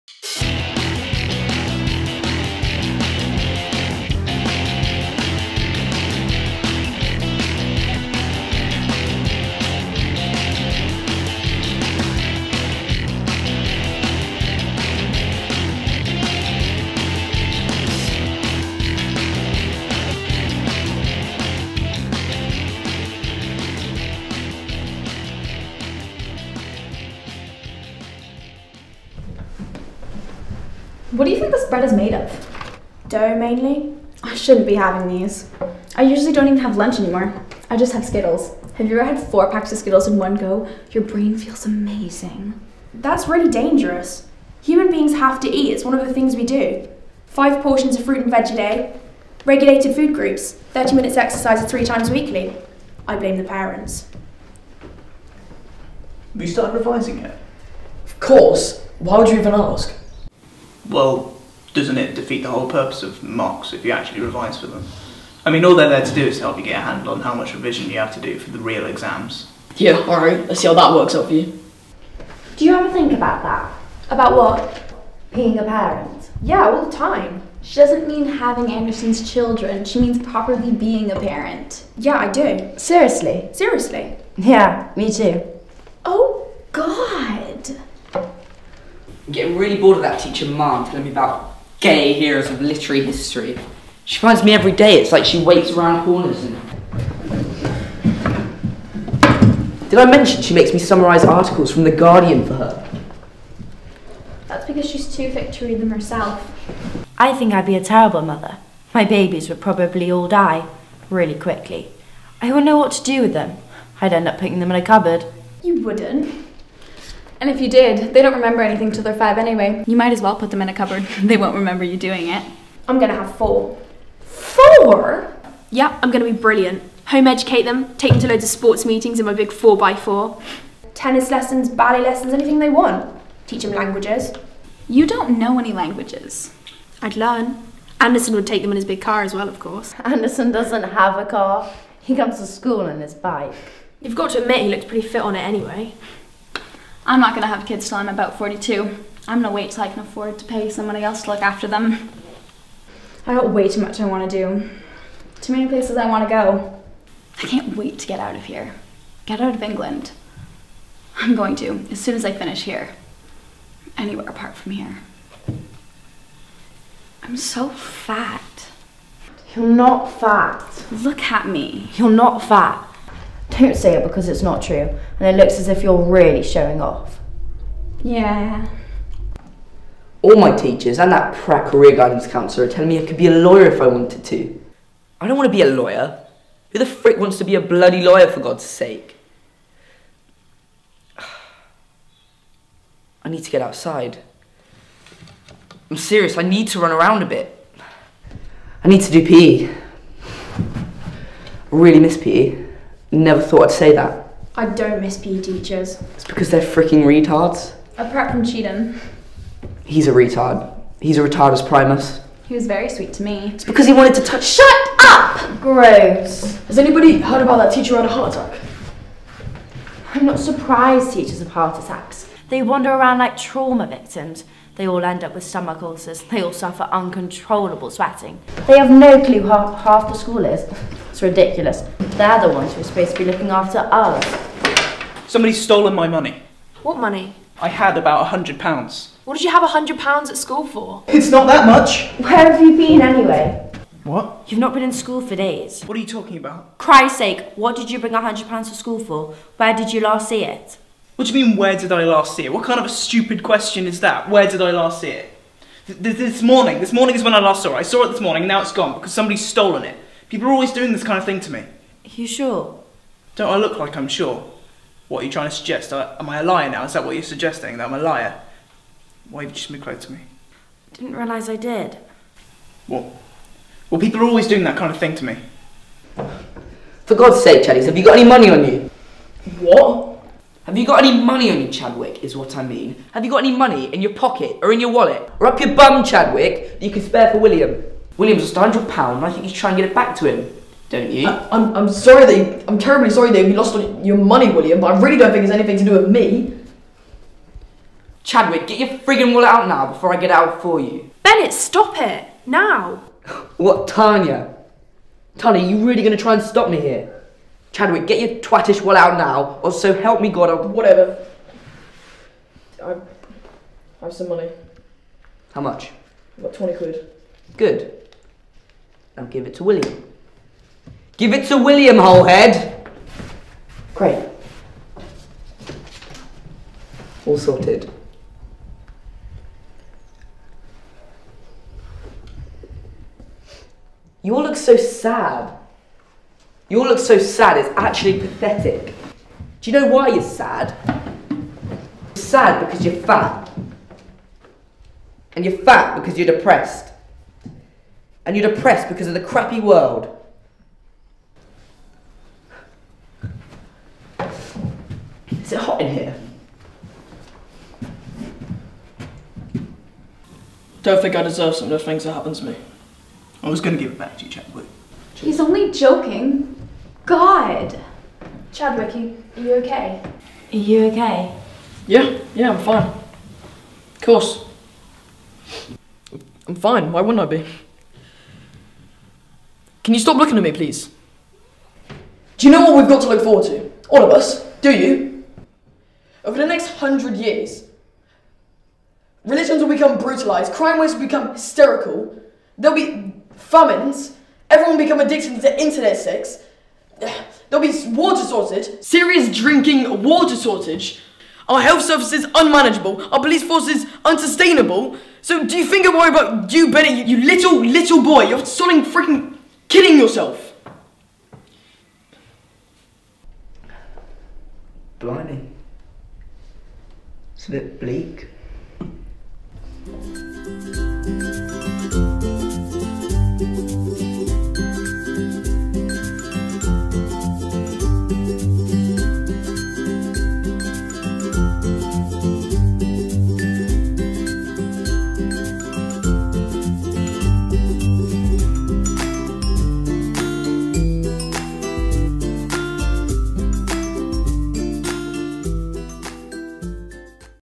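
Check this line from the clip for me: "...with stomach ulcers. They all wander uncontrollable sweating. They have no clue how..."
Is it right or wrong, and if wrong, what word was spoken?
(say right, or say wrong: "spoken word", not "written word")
wrong: "suffer", not "wander".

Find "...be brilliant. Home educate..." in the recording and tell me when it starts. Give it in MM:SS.
02:06.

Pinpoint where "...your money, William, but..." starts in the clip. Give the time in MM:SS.
04:54.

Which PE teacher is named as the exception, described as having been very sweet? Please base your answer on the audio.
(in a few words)
Cheatham.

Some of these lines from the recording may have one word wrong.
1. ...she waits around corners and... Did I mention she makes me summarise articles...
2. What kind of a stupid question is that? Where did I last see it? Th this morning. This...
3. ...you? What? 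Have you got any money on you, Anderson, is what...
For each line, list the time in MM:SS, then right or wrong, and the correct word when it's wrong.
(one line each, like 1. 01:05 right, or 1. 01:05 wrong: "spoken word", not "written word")
1. 01:35 right
2. 04:12 right
3. 04:38 wrong: "Chadwick", not "Anderson".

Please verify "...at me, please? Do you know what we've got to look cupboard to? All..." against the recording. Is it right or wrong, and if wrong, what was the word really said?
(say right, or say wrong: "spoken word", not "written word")
wrong: "forward", not "cupboard".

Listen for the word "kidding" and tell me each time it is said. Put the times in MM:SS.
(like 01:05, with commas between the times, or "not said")
06:49.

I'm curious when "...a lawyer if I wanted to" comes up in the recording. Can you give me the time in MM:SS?
03:03.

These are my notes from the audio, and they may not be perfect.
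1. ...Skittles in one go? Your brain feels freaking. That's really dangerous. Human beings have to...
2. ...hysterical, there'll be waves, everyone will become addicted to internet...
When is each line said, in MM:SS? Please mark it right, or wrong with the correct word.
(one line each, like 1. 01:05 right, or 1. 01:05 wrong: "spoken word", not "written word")
1. 00:39 wrong: "amazing", not "freaking"
2. 06:31 wrong: "famines", not "waves".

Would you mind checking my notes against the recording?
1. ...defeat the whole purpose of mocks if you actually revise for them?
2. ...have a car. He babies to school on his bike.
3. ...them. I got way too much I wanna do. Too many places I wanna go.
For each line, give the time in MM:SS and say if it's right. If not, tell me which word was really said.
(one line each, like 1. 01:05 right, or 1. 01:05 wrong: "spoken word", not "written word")
1. 01:02 right
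2. 02:20 wrong: "comes", not "babies"
3. 02:31 right.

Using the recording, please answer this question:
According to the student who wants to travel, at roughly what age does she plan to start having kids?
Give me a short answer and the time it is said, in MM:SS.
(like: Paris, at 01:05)
42, at 02:28.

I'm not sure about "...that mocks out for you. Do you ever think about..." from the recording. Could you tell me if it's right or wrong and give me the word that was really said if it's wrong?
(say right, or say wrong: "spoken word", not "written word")
wrong: "works", not "mocks".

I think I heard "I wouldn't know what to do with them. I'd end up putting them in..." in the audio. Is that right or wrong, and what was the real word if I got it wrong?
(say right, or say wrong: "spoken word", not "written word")
right.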